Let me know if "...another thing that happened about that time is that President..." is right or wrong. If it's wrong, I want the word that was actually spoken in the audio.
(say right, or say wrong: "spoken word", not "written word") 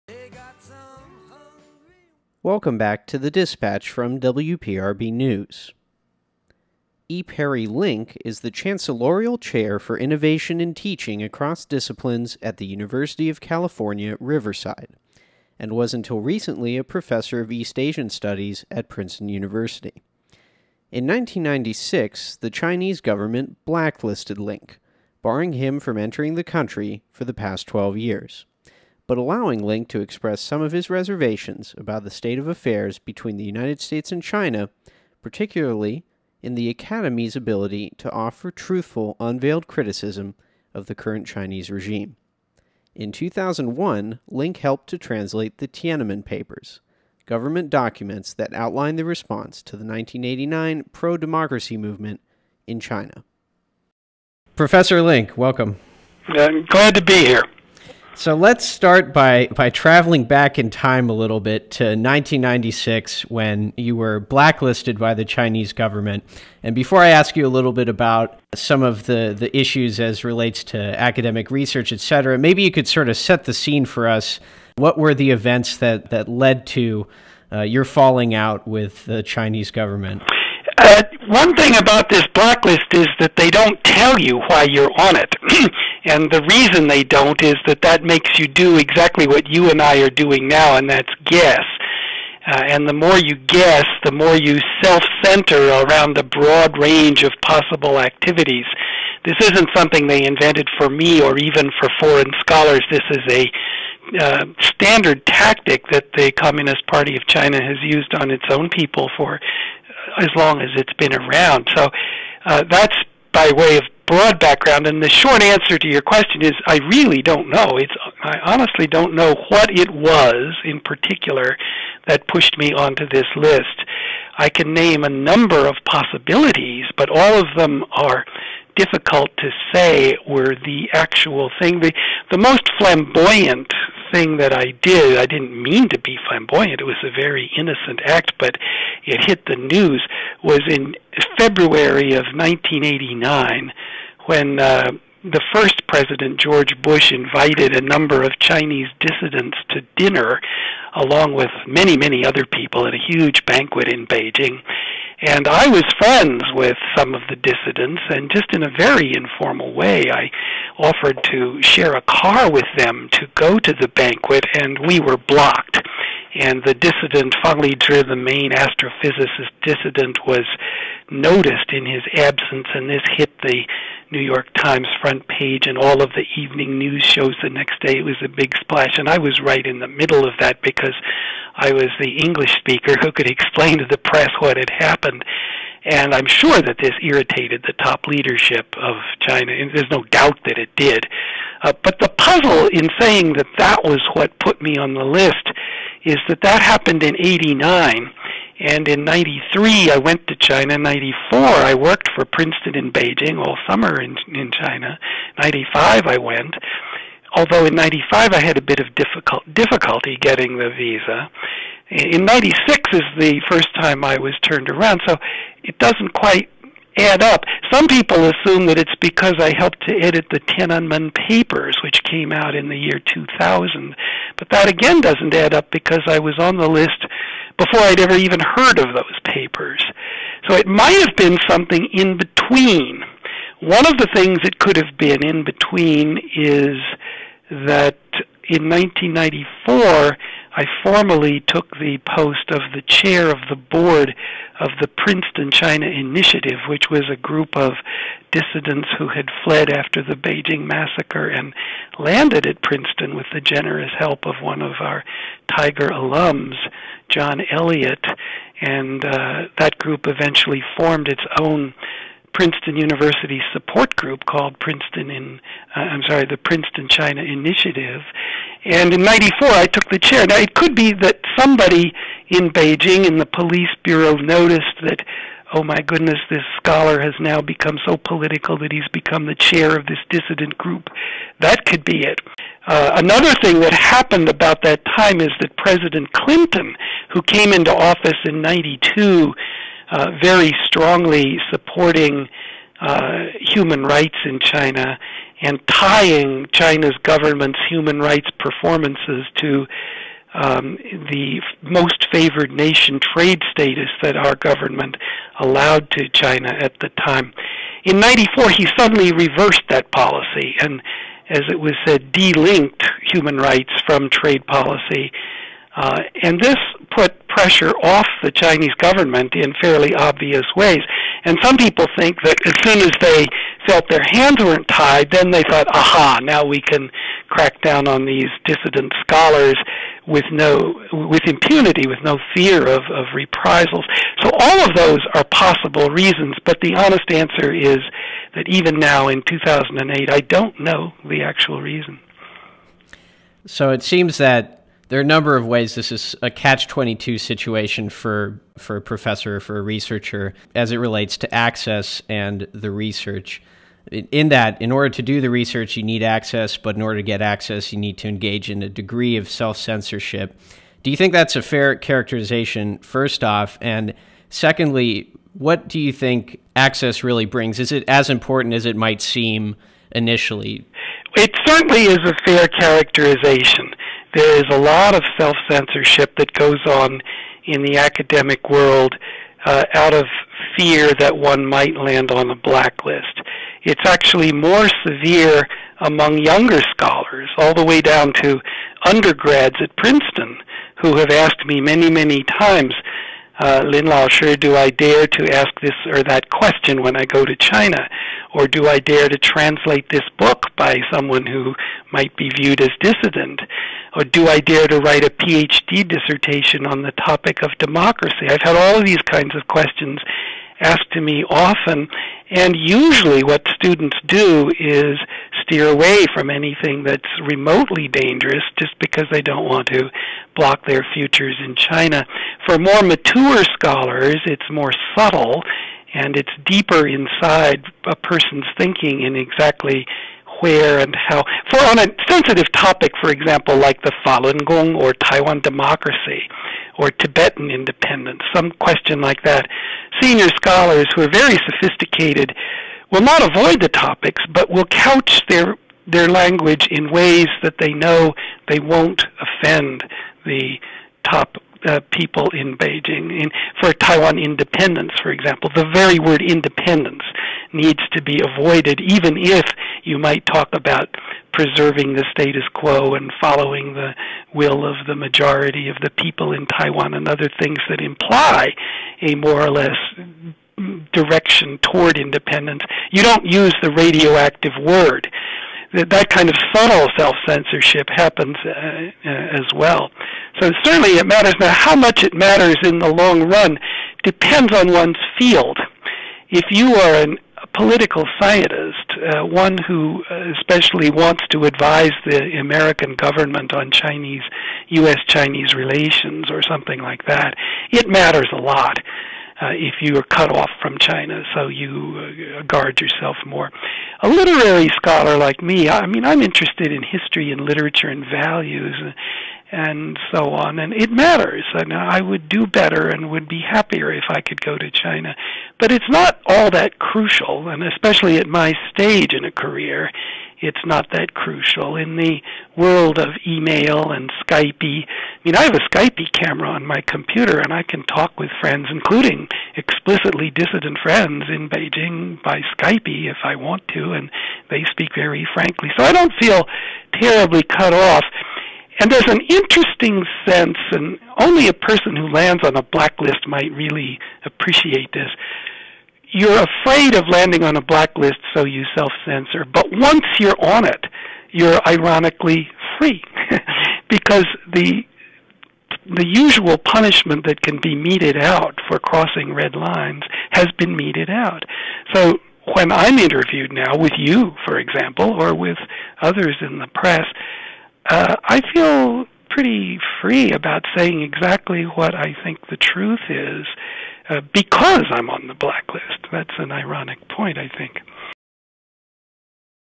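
right.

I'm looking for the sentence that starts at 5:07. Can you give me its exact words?
In 94, he suddenly reversed that policy and as it was said, delinked human rights from trade policy.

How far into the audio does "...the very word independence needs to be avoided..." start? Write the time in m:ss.
7:35.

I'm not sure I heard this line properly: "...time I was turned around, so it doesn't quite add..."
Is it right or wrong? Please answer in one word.
right.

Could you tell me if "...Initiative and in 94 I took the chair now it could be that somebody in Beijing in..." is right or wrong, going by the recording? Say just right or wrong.
right.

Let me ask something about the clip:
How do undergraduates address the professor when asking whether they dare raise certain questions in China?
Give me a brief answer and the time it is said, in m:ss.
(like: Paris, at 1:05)
Lin Lao Shi, at 6:33.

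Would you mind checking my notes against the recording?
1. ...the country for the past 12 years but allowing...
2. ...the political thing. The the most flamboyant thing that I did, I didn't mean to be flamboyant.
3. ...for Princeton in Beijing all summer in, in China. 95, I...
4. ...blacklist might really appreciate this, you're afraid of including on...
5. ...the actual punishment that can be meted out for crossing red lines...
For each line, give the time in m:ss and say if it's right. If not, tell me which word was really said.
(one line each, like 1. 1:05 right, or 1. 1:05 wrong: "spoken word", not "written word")
1. 0:26 right
2. 2:10 wrong: "actual", not "political"
3. 3:22 right
4. 9:02 wrong: "landing", not "including"
5. 9:15 wrong: "usual", not "actual".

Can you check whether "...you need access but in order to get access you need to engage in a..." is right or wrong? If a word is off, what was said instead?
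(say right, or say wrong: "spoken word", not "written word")
right.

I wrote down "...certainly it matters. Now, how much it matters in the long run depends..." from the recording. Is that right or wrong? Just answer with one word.
right.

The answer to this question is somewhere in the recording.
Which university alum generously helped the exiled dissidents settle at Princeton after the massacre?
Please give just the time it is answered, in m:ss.
4:17.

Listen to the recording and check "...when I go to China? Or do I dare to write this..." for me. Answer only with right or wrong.
wrong.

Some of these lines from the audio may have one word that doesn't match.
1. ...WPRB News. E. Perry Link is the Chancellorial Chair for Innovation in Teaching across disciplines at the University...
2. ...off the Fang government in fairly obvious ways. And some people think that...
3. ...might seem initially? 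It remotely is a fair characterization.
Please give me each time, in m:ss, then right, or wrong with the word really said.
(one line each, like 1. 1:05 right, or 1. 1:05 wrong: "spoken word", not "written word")
1. 0:04 right
2. 5:17 wrong: "Chinese", not "Fang"
3. 6:08 wrong: "certainly", not "remotely".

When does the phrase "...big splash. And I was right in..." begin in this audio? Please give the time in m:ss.
2:58.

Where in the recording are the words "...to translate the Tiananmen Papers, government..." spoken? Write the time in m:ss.
0:44.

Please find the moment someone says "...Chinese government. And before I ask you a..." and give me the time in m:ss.
1:05.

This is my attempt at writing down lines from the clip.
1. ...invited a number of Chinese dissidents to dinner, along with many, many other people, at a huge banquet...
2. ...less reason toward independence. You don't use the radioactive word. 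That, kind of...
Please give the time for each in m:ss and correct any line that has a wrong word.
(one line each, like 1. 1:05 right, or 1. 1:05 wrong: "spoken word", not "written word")
1. 2:27 right
2. 7:49 wrong: "direction", not "reason".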